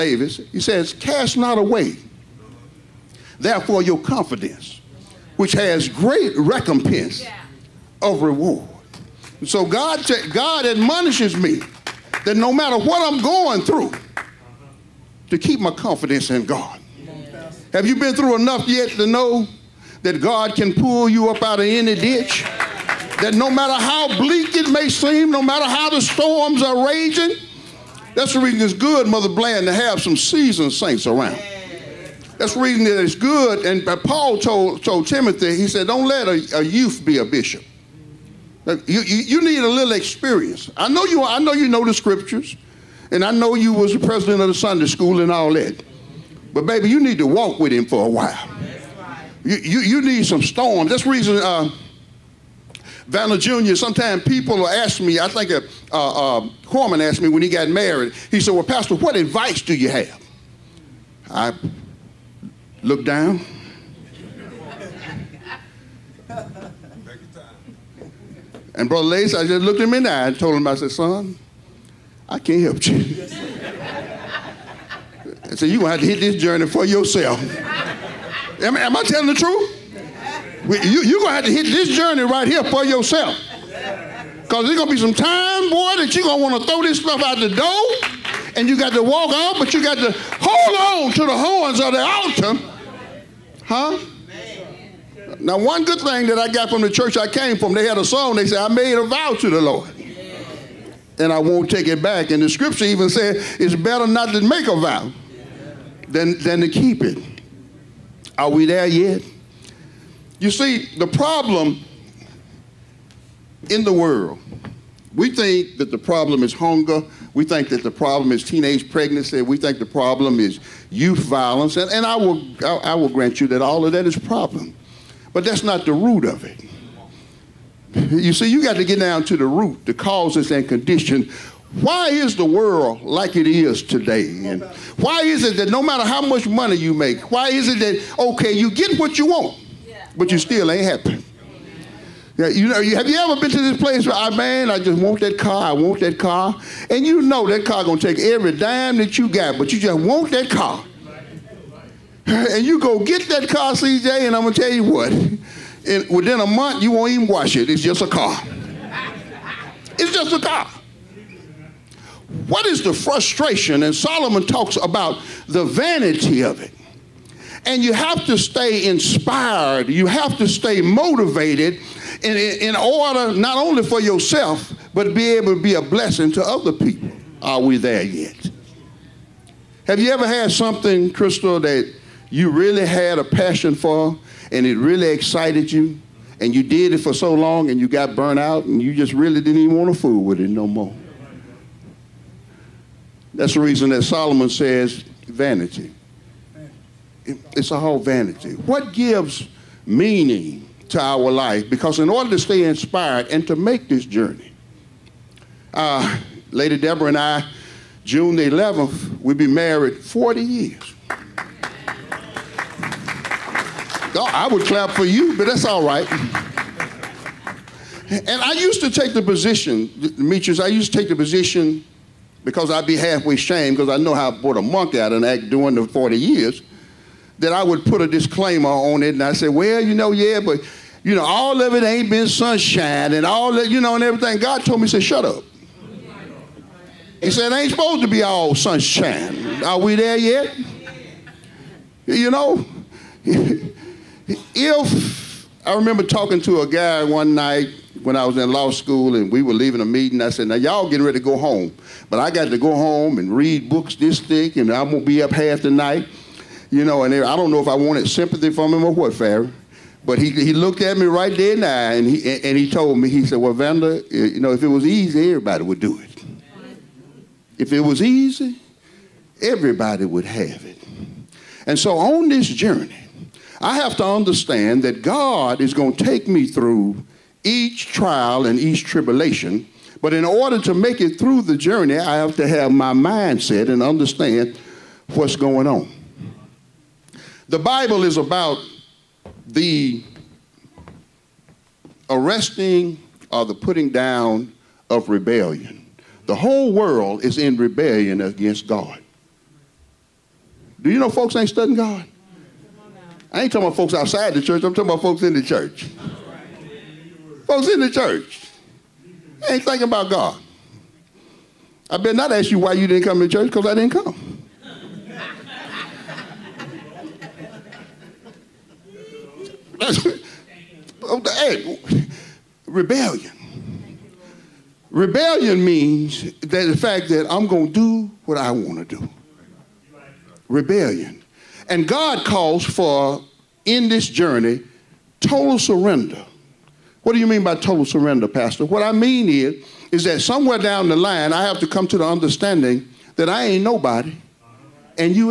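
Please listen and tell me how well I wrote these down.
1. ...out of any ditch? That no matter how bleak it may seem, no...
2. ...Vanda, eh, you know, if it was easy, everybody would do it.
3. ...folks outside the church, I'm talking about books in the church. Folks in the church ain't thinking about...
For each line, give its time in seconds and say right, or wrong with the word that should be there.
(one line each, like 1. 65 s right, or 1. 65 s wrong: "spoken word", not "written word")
1. 21 s right
2. 263 s right
3. 303 s wrong: "folks", not "books".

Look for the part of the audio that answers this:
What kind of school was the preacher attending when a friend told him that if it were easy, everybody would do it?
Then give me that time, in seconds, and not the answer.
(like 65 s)
248 s.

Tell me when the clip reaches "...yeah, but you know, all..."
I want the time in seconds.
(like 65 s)
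230 s.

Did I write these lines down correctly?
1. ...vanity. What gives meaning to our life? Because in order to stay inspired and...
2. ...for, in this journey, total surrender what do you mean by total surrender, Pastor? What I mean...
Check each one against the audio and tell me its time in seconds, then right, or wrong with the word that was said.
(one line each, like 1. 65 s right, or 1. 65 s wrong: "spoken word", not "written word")
1. 197 s right
2. 332 s right.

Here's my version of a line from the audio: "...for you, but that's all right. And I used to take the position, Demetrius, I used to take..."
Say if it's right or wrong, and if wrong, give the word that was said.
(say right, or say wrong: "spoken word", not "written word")
right.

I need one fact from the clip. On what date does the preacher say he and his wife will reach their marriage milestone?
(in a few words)
June 11.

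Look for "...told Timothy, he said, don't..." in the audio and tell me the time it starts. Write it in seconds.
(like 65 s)
34 s.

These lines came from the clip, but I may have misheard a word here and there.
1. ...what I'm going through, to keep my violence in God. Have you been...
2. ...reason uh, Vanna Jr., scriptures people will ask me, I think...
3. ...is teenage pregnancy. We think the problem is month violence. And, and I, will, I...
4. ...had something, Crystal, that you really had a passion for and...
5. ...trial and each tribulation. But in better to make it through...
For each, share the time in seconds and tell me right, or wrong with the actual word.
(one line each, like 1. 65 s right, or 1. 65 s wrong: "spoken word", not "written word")
1. 12 s wrong: "confidence", not "violence"
2. 51 s wrong: "sometimes", not "scriptures"
3. 118 s wrong: "youth", not "month"
4. 180 s right
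5. 277 s wrong: "order", not "better".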